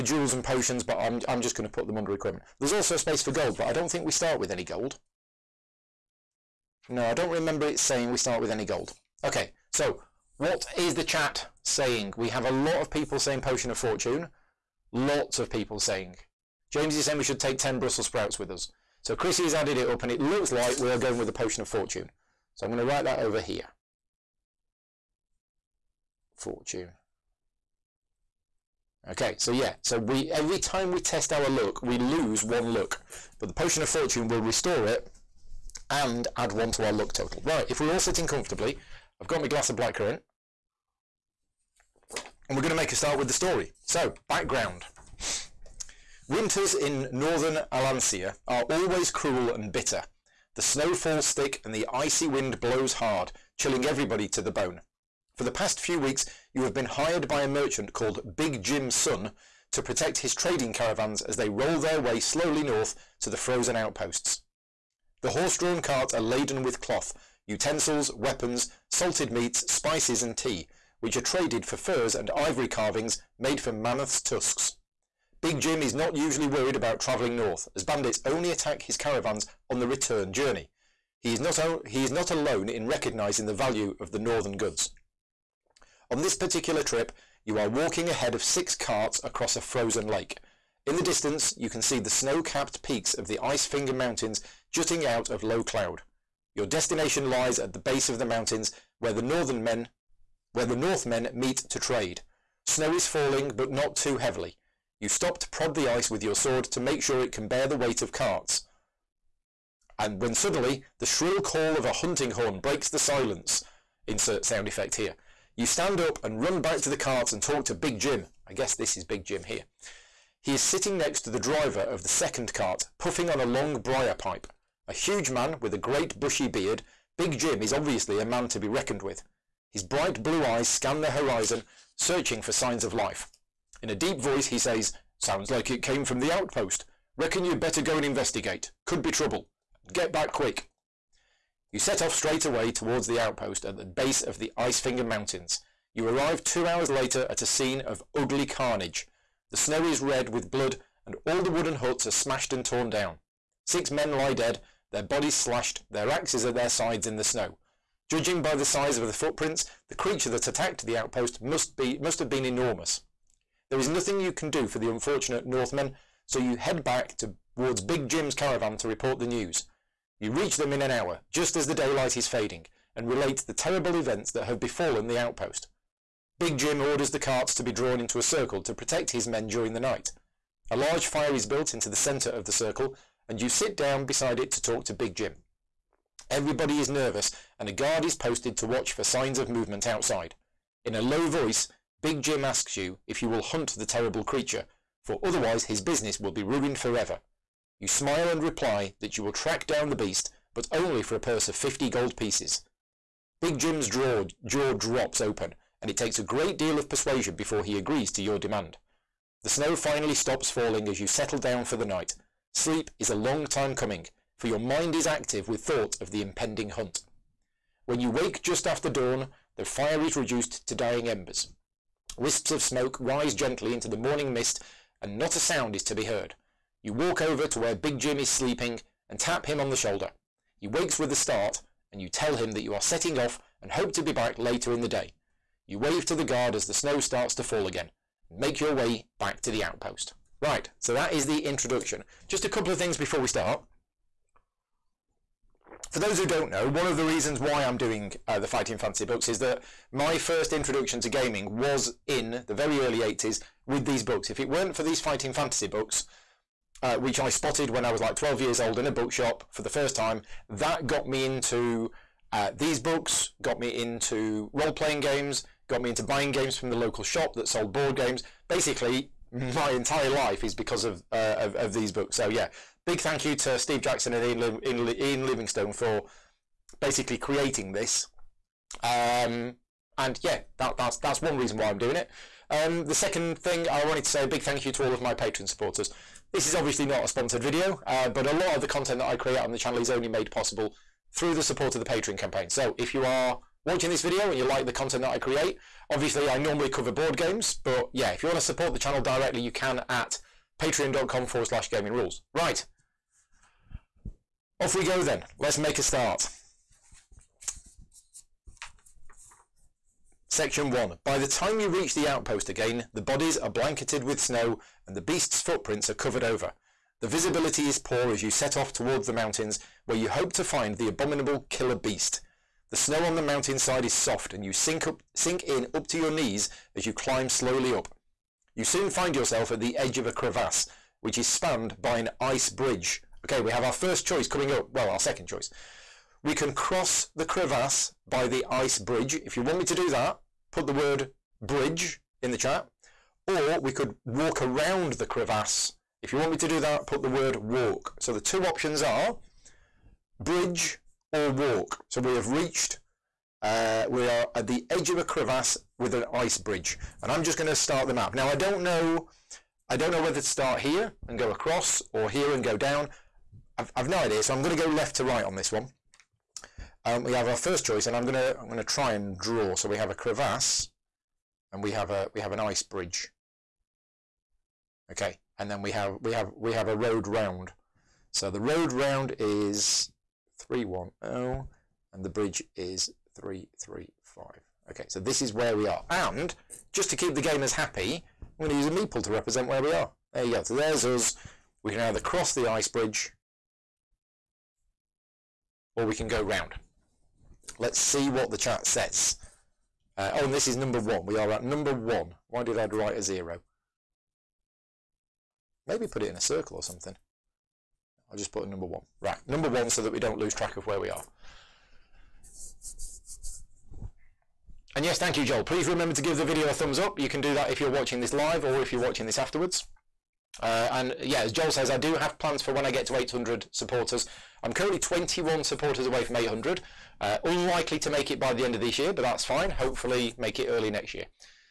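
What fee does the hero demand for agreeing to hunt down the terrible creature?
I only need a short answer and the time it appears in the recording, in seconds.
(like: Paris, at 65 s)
50 gold pieces, at 201 s.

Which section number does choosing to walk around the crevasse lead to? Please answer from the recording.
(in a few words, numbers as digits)
310.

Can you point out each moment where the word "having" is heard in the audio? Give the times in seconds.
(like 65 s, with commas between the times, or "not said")
not said.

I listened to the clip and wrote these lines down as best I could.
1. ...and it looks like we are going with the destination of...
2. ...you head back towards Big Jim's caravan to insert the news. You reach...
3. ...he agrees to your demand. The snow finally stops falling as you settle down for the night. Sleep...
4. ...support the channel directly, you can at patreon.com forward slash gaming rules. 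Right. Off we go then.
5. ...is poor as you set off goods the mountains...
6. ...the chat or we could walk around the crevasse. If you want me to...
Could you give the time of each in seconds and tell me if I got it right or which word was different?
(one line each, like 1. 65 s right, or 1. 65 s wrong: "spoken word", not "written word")
1. 20 s wrong: "potion", not "destination"
2. 166 s wrong: "report", not "insert"
3. 207 s right
4. 298 s right
5. 317 s wrong: "towards", not "goods"
6. 342 s right.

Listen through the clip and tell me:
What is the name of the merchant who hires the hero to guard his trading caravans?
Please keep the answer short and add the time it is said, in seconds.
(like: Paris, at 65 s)
Big Jim Sun, at 58 s.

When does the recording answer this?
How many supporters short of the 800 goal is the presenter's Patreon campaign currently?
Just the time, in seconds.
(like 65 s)
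424 s.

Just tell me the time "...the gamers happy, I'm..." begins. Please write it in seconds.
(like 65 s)
387 s.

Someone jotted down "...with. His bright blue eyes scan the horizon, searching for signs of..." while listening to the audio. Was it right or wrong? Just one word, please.
right.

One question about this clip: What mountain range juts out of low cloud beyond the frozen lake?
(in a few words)
Ice Finger Mountains.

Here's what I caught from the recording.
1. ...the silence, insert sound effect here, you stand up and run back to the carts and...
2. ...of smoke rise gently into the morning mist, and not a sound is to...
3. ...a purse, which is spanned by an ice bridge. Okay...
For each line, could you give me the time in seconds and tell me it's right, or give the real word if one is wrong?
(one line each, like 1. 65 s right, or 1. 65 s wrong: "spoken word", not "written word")
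1. 112 s right
2. 222 s right
3. 330 s wrong: "crevasse", not "purse".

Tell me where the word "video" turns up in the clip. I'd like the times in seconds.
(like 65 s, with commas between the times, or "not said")
287 s, 294 s, 416 s.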